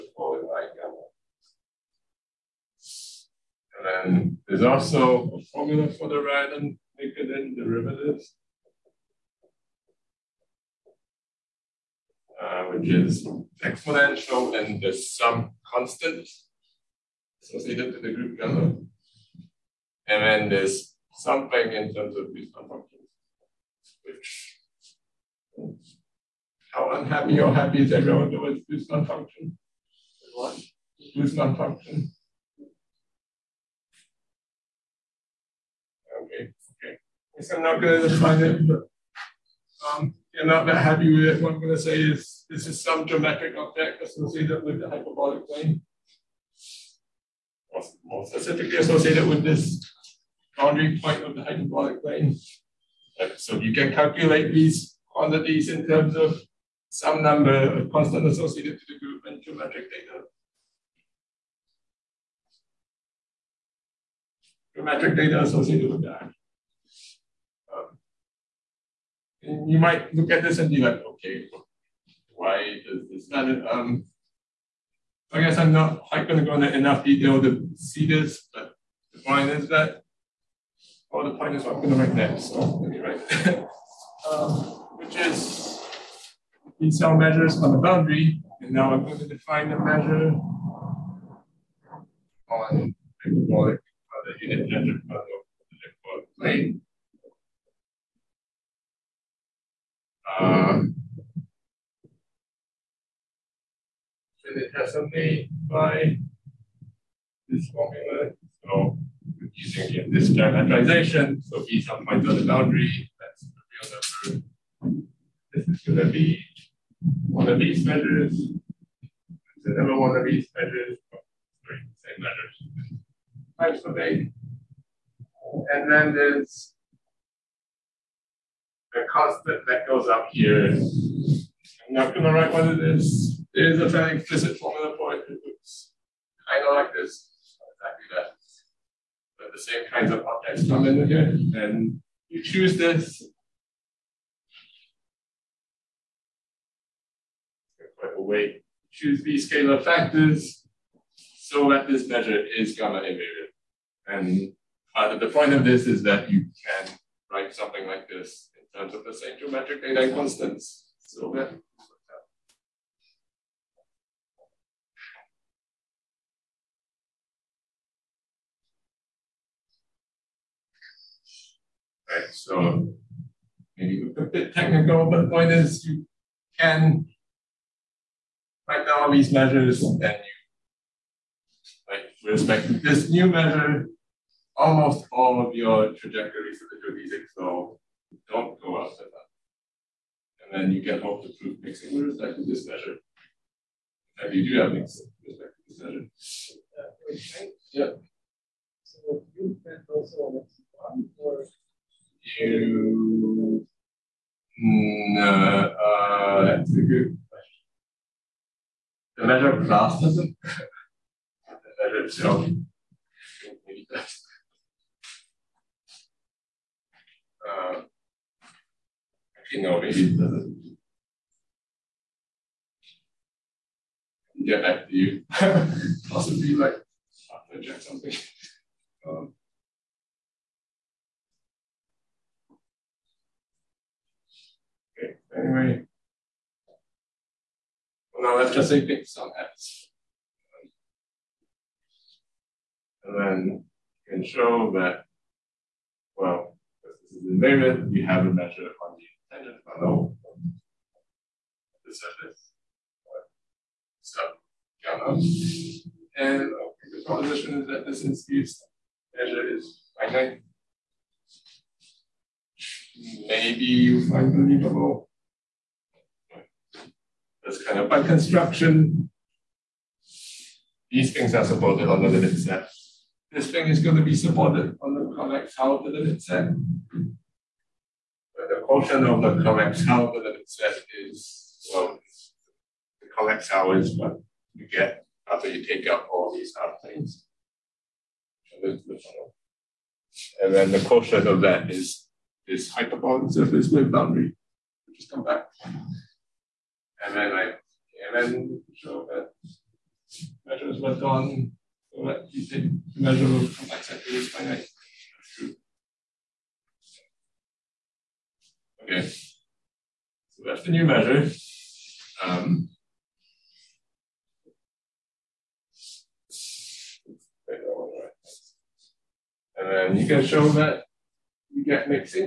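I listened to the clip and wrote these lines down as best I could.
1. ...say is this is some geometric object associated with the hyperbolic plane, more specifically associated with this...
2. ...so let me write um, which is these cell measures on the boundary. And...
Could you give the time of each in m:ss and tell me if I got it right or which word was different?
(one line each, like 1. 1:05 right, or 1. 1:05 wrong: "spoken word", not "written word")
1. 0:41 right
2. 1:22 right.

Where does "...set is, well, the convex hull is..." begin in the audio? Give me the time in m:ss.
4:40.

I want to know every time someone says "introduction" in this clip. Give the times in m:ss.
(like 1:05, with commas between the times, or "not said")
not said.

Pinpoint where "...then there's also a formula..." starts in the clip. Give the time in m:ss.
0:03.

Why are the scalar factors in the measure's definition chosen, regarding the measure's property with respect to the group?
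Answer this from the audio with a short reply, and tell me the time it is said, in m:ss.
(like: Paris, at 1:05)
gamma invariant, at 2:32.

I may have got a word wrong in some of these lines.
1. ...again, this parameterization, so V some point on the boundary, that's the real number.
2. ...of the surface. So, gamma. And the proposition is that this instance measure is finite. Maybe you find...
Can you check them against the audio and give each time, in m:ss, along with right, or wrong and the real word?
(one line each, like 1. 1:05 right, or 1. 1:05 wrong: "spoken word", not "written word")
1. 1:49 right
2. 4:10 right.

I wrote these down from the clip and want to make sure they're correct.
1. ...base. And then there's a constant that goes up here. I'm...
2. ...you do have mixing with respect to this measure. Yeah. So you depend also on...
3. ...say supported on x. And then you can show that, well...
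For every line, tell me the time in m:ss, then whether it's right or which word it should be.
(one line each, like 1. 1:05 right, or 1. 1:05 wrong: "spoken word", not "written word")
1. 2:03 right
2. 3:14 right
3. 3:58 wrong: "based", not "supported".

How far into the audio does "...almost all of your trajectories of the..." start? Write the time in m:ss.
3:04.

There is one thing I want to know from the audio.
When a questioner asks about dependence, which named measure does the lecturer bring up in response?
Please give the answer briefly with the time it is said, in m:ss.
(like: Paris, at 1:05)
the Margulis measure, at 3:29.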